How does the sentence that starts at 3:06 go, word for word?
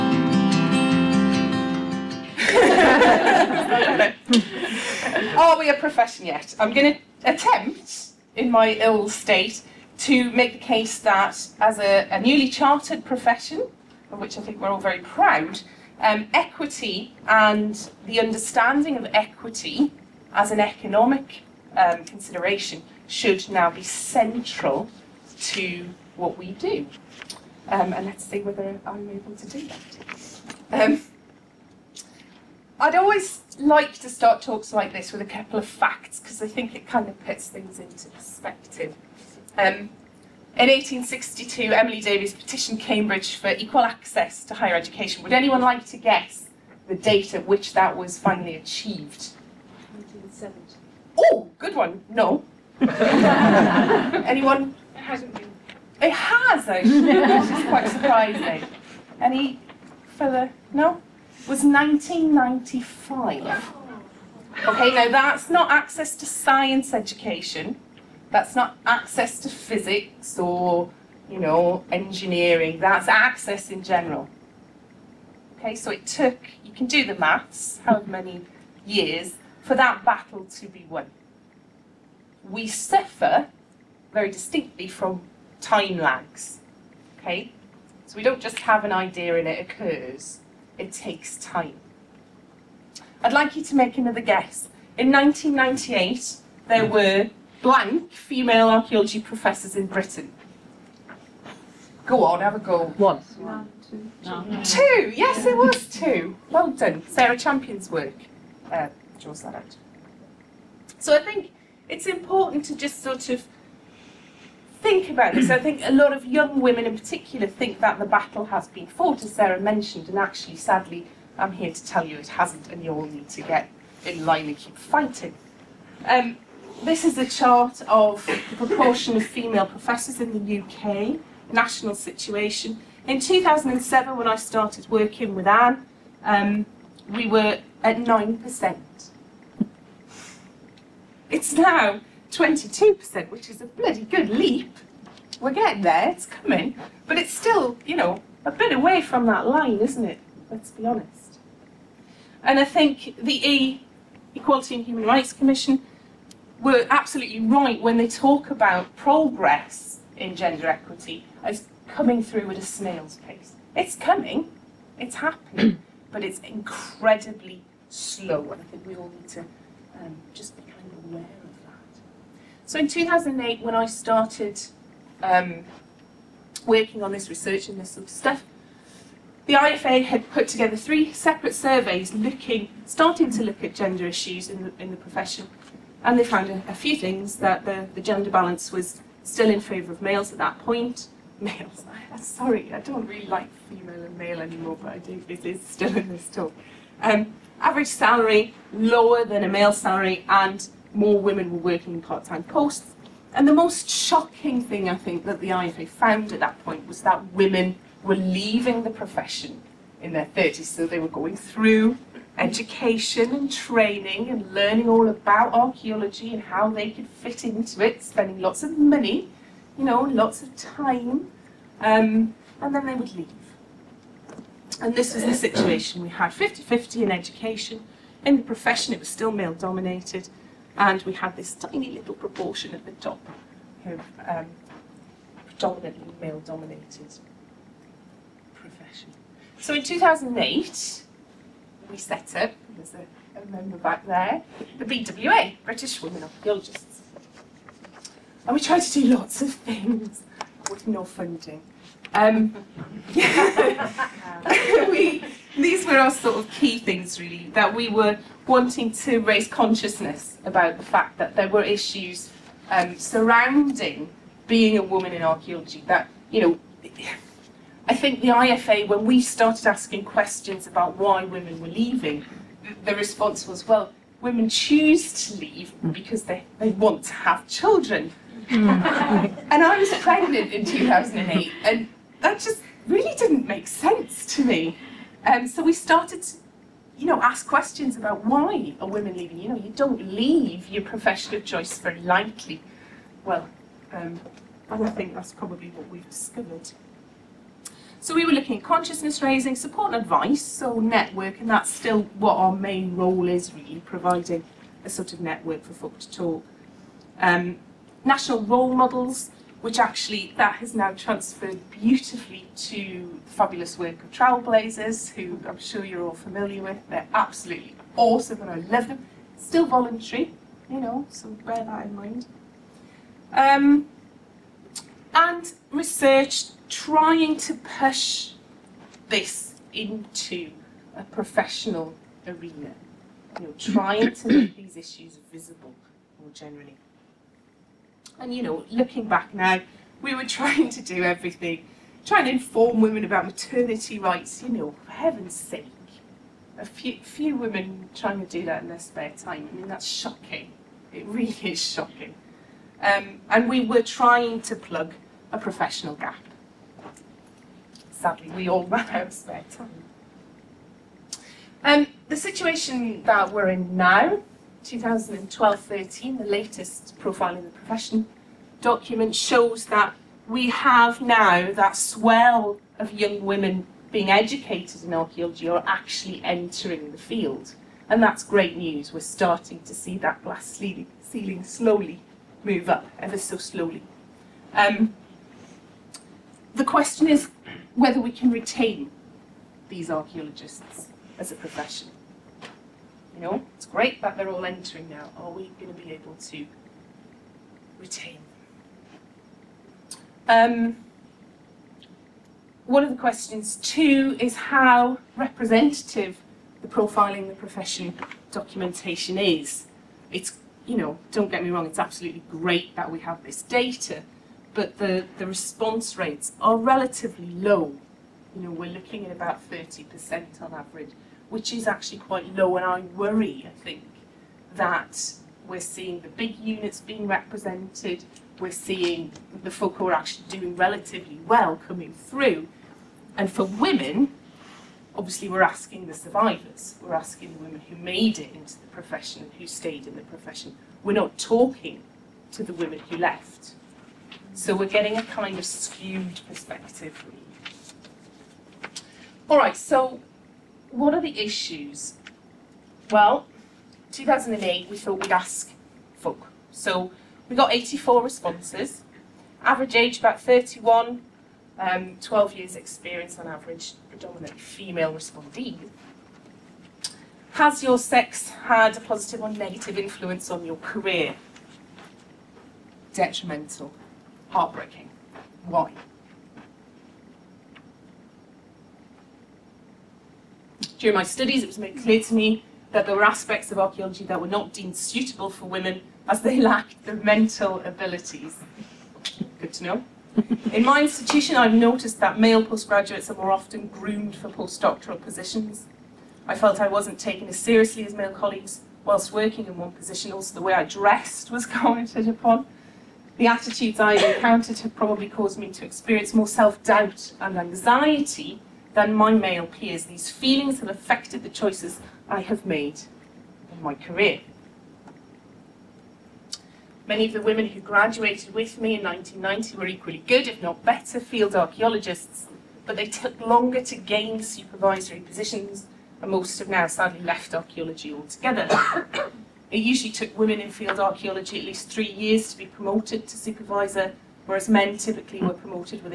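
And they found a, a few things that the, the gender balance was still in favour of males at that point.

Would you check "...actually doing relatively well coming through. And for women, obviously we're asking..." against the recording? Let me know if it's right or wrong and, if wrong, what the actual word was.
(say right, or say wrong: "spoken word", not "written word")
right.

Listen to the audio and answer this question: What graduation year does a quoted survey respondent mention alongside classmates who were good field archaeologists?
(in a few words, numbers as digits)
1990.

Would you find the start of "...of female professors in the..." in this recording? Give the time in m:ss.
2:09.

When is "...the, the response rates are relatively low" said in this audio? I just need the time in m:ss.
6:54.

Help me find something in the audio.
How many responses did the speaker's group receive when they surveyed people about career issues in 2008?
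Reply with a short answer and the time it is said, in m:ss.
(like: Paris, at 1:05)
84, at 7:37.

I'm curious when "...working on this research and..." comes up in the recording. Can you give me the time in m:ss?
2:56.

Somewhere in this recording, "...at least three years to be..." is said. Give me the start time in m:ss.
8:51.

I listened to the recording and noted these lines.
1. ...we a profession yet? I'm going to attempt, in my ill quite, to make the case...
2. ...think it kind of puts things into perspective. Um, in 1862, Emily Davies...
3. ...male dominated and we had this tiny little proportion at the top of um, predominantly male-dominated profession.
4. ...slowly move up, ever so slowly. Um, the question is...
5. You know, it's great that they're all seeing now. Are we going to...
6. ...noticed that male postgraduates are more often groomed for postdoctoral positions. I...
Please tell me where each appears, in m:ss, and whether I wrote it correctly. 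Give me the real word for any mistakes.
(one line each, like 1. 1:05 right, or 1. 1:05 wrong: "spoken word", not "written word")
1. 0:05 wrong: "state", not "quite"
2. 0:36 right
3. 3:49 right
4. 6:21 right
5. 6:33 wrong: "entering", not "seeing"
6. 8:11 right.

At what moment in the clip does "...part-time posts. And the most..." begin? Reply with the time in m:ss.
3:22.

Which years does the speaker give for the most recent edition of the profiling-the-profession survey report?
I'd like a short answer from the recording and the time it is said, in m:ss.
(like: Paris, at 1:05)
2012-13, at 6:04.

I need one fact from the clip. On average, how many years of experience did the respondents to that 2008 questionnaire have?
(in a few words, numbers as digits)
12 years.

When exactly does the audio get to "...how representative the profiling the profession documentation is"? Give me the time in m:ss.
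6:44.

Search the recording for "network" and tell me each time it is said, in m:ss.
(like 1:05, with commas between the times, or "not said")
5:00, 5:05.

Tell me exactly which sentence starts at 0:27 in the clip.
Um, and let's see whether I'm able to do that.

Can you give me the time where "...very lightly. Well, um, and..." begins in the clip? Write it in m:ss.
4:51.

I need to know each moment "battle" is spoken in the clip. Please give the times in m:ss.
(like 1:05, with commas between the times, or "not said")
1:20, 1:58.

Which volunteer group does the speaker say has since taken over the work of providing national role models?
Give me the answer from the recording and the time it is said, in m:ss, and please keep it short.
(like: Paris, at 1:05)
Trailblazers, at 5:14.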